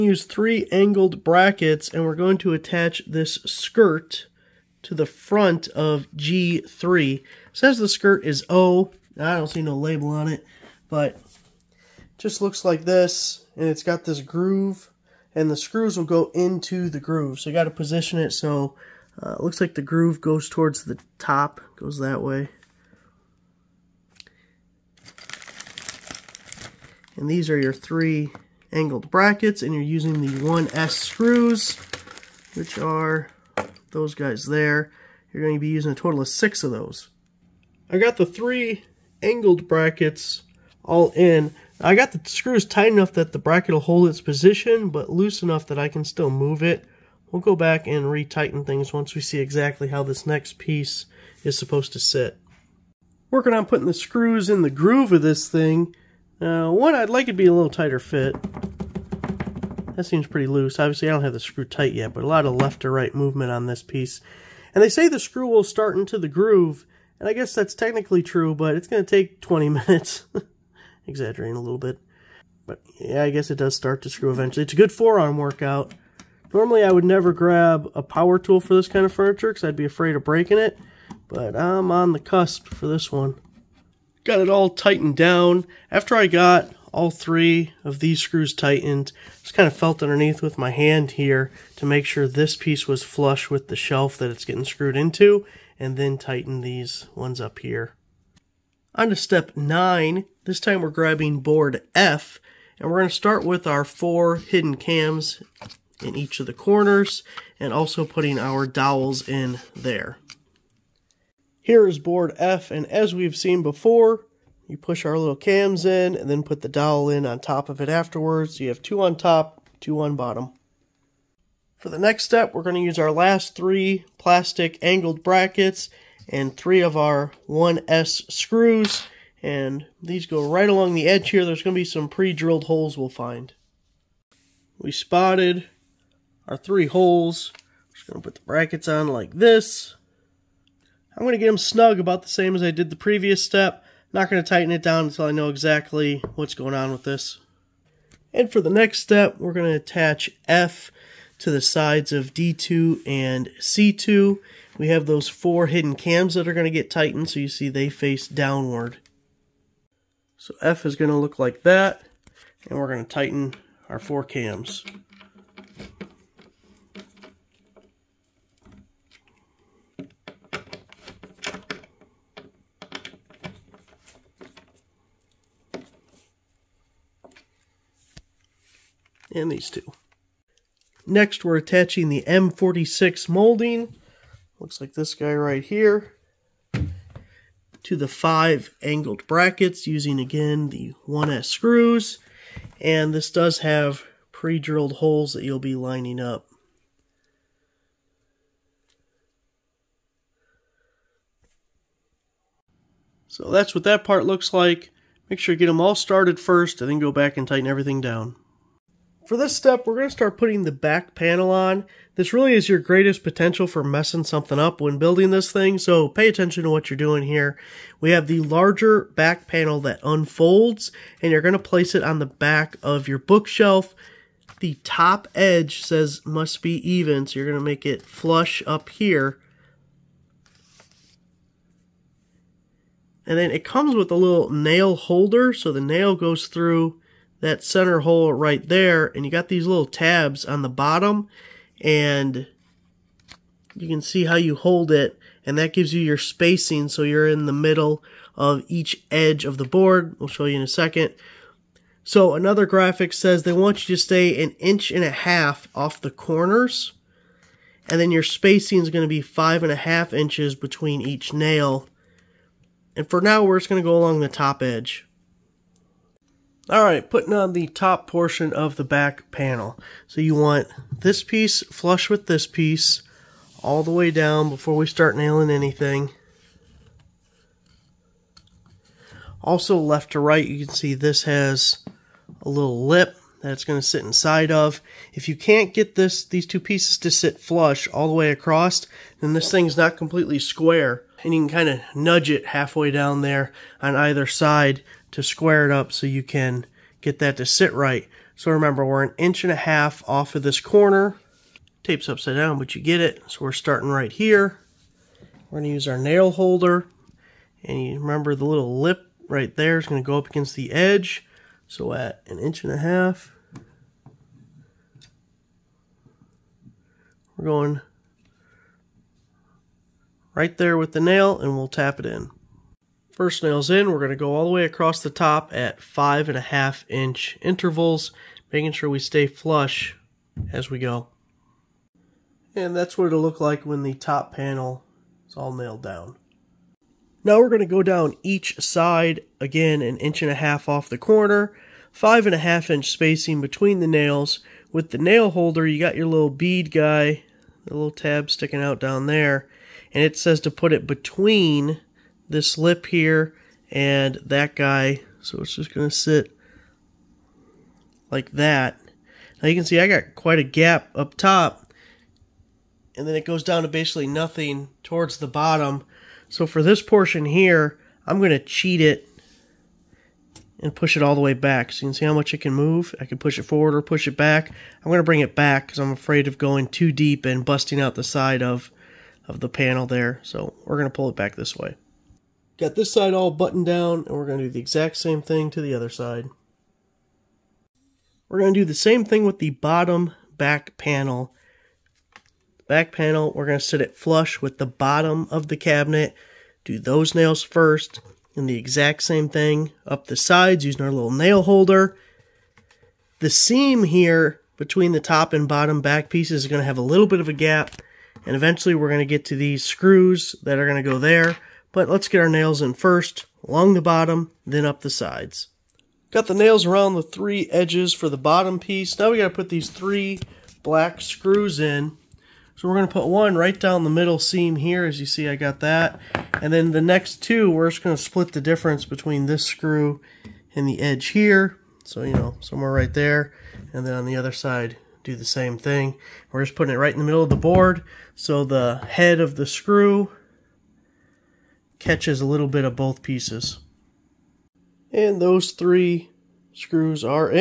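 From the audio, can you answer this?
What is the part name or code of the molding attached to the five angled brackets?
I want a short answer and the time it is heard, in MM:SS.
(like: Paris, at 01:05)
M46, at 03:02.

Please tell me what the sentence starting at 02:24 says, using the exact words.
Not going to tighten it down until I know exactly what's going on with this.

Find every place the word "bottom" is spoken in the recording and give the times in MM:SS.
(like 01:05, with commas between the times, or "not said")
02:00, 04:00, 06:05, 06:29, 06:34, 06:45, 06:53, 06:58.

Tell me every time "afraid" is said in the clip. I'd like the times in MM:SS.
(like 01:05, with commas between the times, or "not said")
01:19, 06:15.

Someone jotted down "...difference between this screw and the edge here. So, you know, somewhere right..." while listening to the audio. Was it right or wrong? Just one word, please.
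right.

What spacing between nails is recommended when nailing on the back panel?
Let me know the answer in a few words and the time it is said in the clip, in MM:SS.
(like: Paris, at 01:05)
5.5 inches, at 04:19.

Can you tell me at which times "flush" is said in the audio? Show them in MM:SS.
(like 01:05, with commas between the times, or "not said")
01:33, 03:48, 04:31, 04:47, 05:29, 06:33.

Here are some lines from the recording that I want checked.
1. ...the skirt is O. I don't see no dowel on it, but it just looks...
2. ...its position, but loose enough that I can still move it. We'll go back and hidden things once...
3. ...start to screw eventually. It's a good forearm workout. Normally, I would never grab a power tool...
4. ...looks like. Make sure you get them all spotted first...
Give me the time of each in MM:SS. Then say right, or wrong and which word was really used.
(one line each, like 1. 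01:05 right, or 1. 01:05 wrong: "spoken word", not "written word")
1. 00:07 wrong: "label", not "dowel"
2. 00:44 wrong: "retighten", not "hidden"
3. 01:13 right
4. 03:24 wrong: "started", not "spotted".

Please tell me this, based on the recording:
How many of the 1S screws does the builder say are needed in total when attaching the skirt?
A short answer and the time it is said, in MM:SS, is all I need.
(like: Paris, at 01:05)
6, at 00:35.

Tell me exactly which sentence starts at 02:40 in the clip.
So F is going to look like that, and we're going to tighten our four cams.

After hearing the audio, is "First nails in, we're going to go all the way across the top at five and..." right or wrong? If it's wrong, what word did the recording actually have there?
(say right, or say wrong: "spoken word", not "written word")
right.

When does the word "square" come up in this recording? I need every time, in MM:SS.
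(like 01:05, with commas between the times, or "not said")
04:50, 04:55.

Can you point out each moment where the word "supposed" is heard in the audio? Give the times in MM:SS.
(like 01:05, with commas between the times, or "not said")
00:51.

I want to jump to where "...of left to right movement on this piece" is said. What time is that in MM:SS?
01:02.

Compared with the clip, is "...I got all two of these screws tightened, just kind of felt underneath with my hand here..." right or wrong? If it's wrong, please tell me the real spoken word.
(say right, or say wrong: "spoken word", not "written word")
wrong: "three", not "two".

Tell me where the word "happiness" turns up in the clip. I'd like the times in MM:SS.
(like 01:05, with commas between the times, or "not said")
not said.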